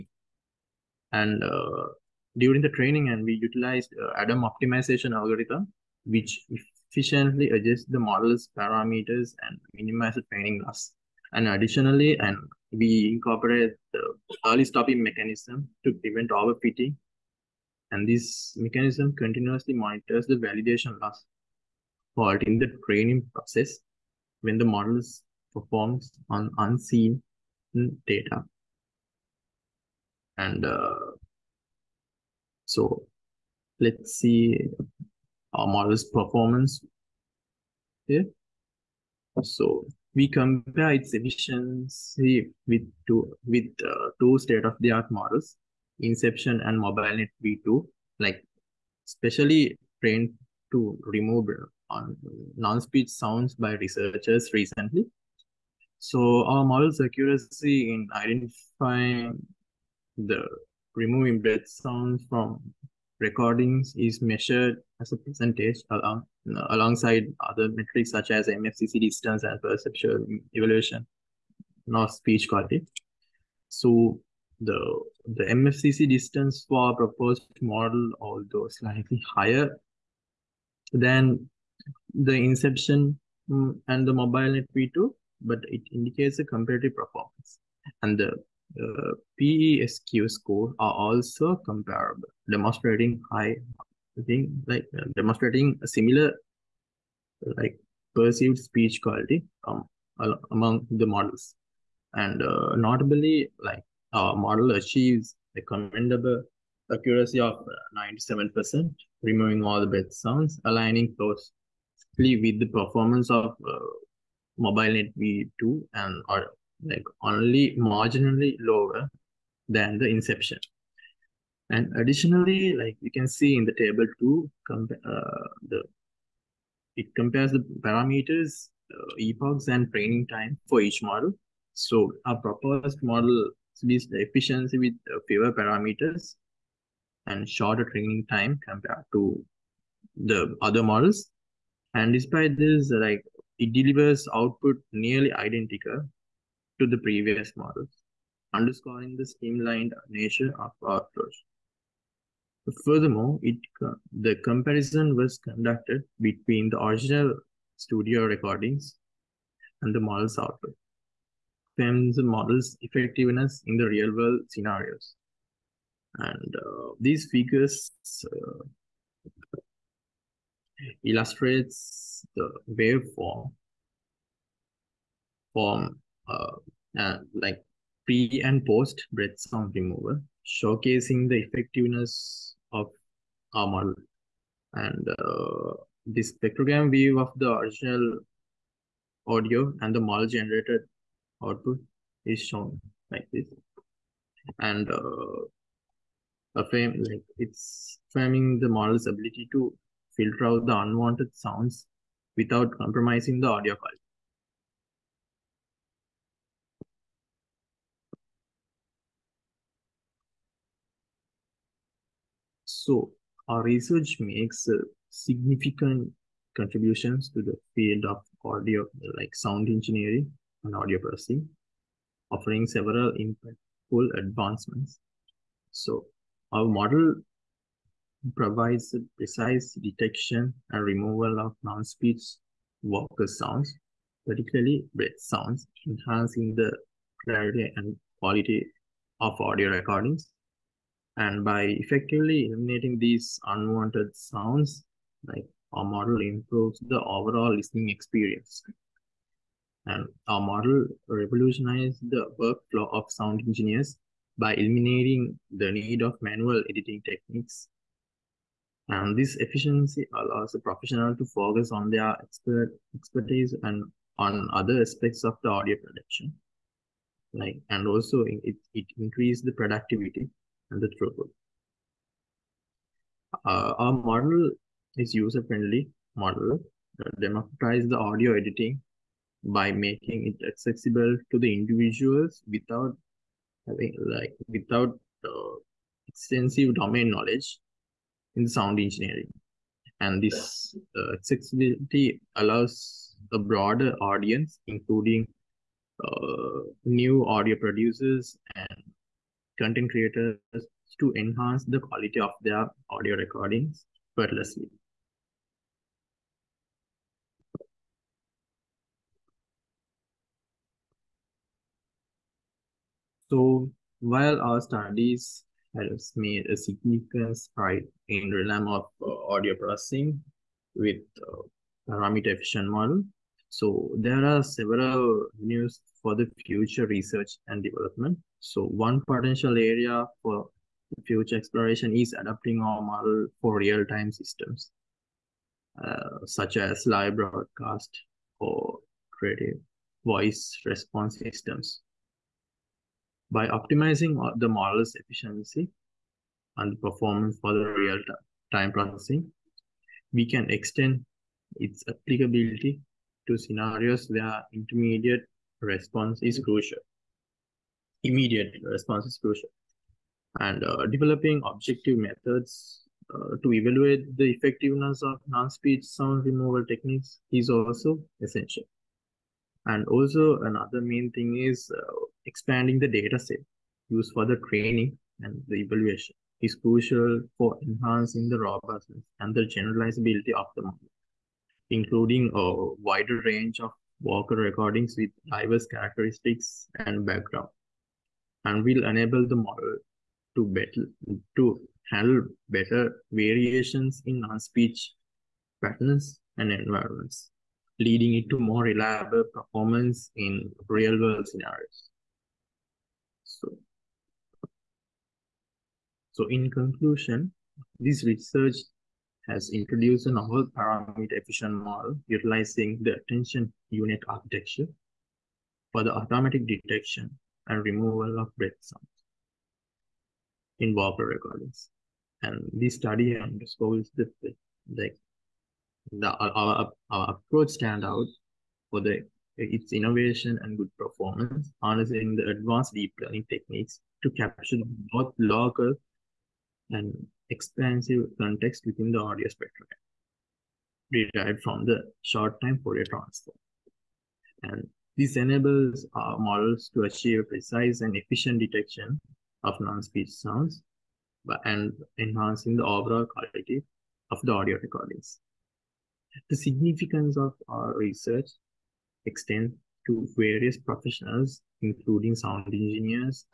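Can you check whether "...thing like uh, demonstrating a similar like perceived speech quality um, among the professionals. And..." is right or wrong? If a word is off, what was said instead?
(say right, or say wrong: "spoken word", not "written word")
wrong: "models", not "professionals".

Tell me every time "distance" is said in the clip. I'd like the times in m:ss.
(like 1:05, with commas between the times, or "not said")
1:08, 1:16.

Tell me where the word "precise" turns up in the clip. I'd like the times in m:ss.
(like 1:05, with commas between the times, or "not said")
3:49, 7:27.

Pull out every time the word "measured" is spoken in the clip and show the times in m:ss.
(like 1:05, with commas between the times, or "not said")
1:04.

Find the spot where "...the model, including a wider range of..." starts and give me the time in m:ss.
6:20.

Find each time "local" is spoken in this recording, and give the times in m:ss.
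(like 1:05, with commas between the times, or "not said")
7:15.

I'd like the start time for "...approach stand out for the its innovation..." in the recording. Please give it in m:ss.
7:07.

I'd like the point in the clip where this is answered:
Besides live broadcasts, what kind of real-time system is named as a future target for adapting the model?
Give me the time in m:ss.
5:39.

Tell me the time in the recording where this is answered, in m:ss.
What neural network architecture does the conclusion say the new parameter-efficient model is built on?
6:52.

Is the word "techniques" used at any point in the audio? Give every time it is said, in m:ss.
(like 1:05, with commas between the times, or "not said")
4:17, 6:06, 7:13.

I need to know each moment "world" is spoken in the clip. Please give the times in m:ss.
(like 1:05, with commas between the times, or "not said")
2:43, 6:41.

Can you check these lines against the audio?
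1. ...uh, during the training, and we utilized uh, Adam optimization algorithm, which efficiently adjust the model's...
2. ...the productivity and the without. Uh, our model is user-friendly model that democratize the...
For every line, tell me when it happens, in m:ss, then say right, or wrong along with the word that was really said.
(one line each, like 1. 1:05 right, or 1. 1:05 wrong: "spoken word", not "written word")
1. 0:01 right
2. 4:29 wrong: "throughput", not "without".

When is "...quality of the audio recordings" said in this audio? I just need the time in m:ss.
7:33.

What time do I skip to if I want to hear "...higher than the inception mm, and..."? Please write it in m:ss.
1:19.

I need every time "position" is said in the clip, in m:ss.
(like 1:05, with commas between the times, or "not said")
not said.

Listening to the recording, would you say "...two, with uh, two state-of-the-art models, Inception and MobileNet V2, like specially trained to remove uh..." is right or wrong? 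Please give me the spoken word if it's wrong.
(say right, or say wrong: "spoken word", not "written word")
right.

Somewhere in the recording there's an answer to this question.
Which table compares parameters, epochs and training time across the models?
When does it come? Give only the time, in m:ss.
2:03.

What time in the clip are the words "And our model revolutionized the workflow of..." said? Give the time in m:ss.
4:09.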